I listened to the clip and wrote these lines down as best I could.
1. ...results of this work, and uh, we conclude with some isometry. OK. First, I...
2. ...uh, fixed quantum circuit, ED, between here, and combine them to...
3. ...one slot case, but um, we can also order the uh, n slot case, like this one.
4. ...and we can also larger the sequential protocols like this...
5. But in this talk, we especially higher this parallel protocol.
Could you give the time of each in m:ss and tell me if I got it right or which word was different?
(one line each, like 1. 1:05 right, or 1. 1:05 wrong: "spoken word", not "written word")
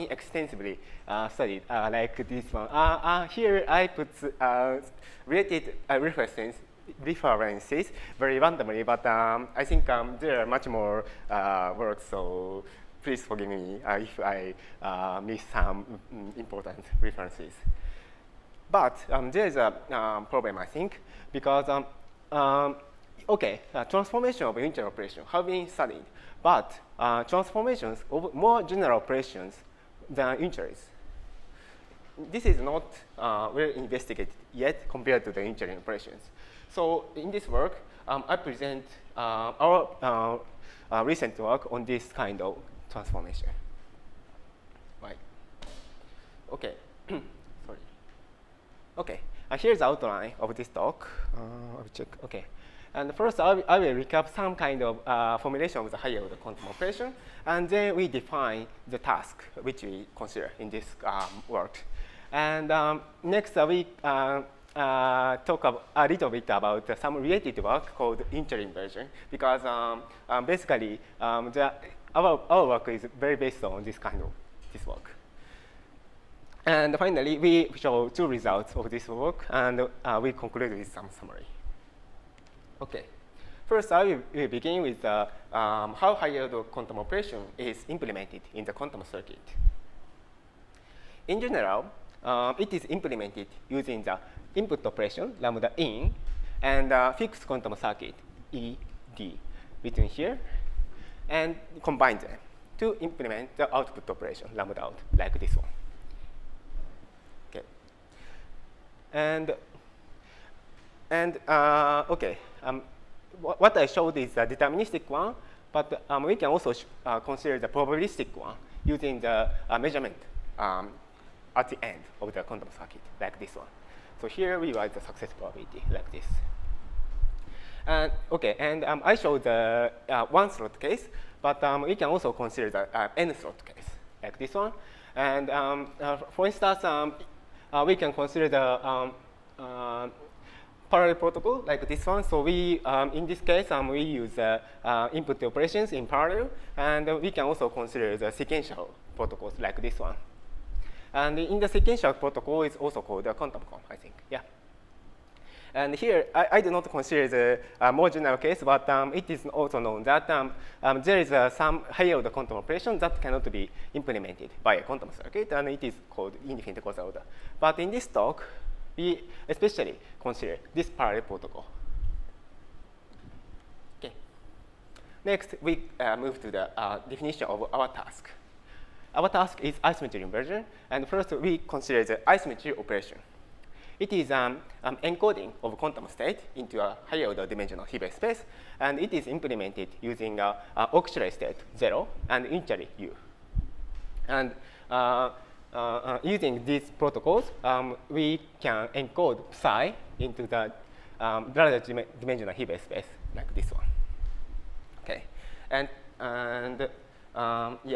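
1. 1:18 wrong: "summary", not "isometry"
2. 1:36 right
3. 2:10 wrong: "consider", not "order"
4. 2:26 wrong: "consider", not "larger"
5. 2:47 wrong: "consider", not "higher".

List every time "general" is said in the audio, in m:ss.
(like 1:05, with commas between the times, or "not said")
0:28, 1:31, 2:38.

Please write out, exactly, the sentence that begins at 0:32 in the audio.
This is not uh, well investigated yet compared to the unitary operations.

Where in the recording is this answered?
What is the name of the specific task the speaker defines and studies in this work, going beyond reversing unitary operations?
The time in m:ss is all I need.
2:59.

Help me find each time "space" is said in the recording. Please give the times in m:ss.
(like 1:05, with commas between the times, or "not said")
3:08, 3:22.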